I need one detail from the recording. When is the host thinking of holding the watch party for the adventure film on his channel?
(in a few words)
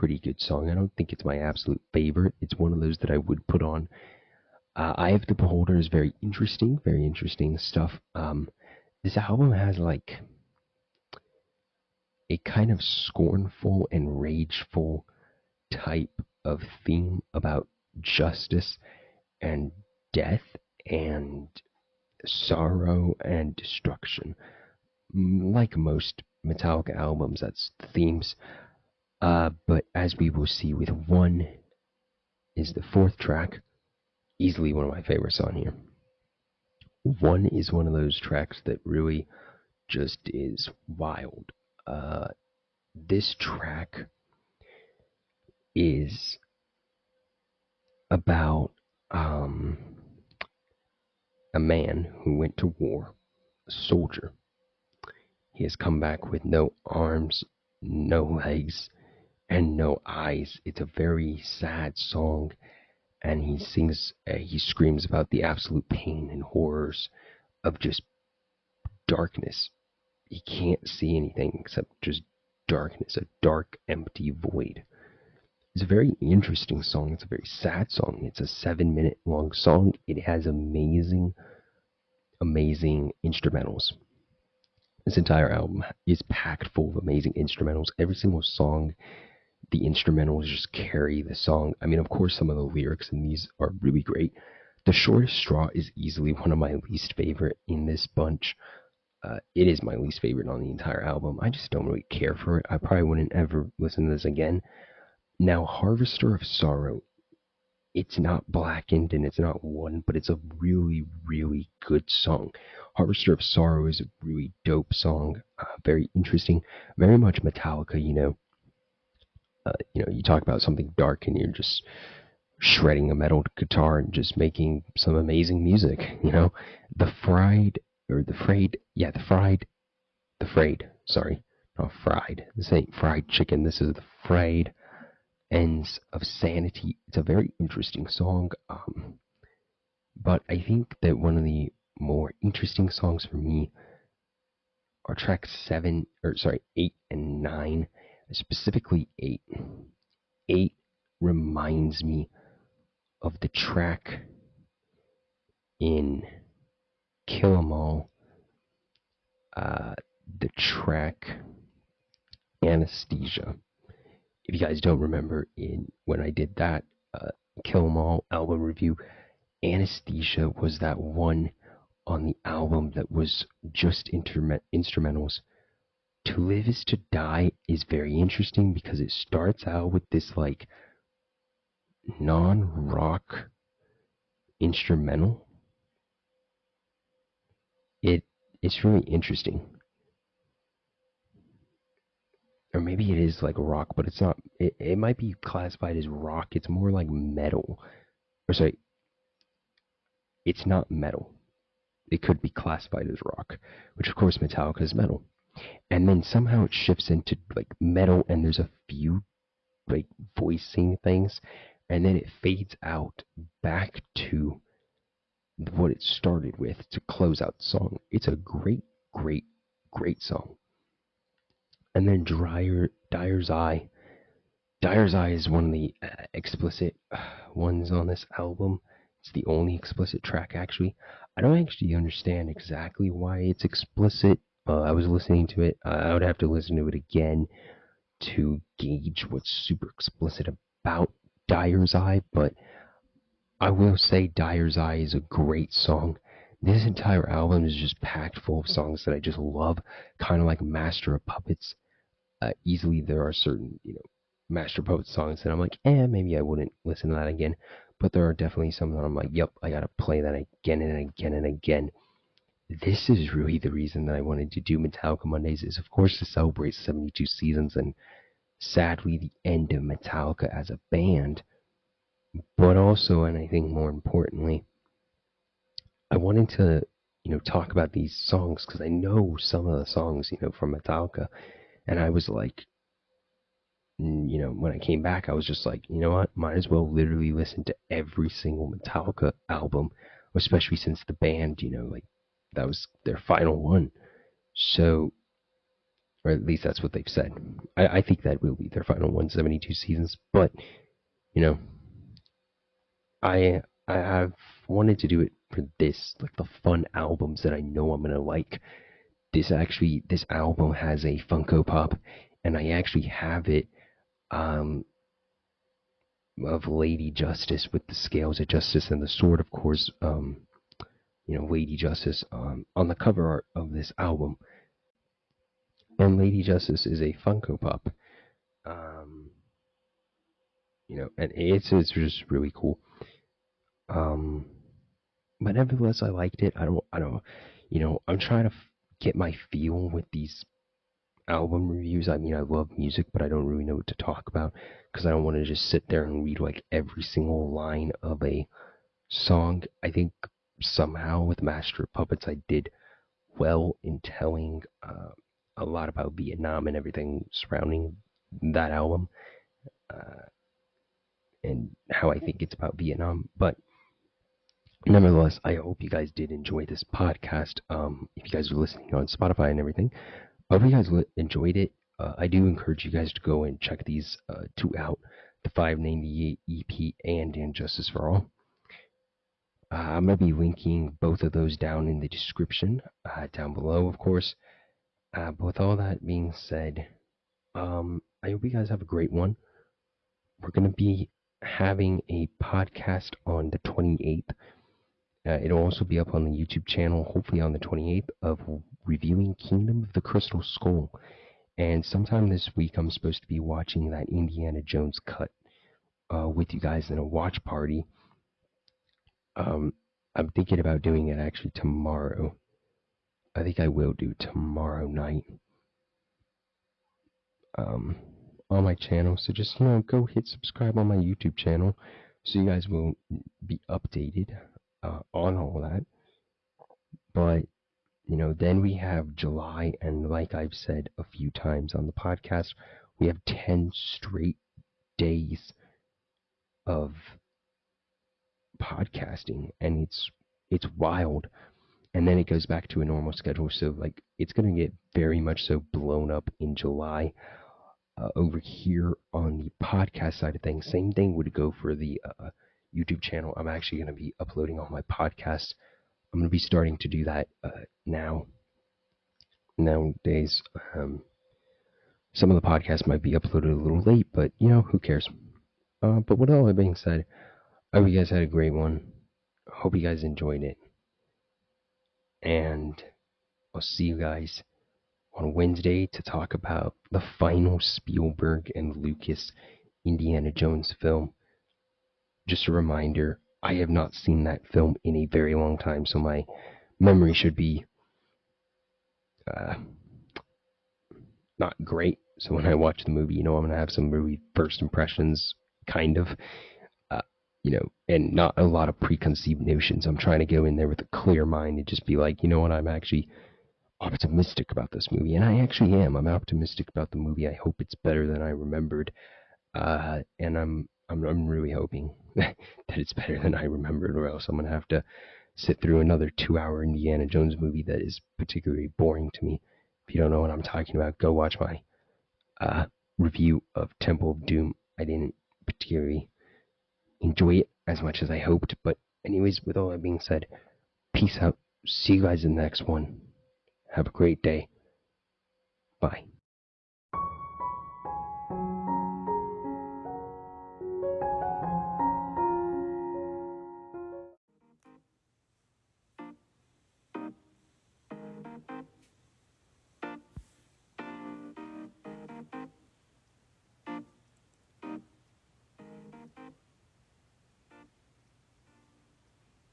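Tomorrow night.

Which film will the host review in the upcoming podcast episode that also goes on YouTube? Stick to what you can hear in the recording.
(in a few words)
Kingdom of the Crystal Skull.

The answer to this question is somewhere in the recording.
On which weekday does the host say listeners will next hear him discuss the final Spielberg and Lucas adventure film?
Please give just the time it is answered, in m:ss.
7:55.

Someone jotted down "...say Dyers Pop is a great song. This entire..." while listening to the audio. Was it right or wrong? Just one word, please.
wrong.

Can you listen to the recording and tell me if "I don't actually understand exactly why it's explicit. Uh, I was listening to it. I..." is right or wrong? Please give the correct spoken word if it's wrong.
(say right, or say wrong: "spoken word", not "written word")
right.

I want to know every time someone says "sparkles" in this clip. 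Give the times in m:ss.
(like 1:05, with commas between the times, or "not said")
not said.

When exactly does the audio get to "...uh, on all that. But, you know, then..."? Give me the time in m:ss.
7:04.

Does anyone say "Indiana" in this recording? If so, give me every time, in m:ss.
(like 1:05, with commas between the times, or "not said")
6:44, 7:59, 8:36.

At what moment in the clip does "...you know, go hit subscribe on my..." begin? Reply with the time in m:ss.
6:59.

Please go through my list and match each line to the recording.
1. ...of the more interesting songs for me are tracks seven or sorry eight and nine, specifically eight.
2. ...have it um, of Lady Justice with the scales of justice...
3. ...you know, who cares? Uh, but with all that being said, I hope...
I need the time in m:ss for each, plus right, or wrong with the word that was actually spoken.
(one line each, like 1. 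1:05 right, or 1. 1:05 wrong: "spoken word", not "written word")
1. 2:21 right
2. 5:13 right
3. 7:44 right.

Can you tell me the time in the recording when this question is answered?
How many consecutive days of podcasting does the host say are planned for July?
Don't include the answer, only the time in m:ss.
7:13.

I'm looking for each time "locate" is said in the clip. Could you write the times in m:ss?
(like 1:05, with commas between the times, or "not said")
not said.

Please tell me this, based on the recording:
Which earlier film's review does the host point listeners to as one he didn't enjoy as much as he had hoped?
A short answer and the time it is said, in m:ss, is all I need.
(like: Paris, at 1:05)
Temple of Doom, at 8:43.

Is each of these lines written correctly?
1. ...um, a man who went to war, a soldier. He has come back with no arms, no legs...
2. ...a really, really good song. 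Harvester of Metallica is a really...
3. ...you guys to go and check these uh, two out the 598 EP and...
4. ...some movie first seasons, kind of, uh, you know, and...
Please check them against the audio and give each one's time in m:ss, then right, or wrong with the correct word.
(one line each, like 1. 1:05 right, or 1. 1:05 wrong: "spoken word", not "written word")
1. 0:49 right
2. 1:50 wrong: "Sorrow", not "Metallica"
3. 6:12 right
4. 8:13 wrong: "impressions", not "seasons".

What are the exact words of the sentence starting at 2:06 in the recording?
The Fried, or The Frayed, yeah, The Fried, The Frayed, sorry, not Fried.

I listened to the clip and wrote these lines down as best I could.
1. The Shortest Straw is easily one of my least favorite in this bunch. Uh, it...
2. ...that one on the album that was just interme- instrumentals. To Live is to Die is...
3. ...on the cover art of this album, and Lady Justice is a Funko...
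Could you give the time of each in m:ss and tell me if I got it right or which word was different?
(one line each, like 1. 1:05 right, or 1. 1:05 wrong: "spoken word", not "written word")
1. 1:34 right
2. 2:50 right
3. 5:22 right.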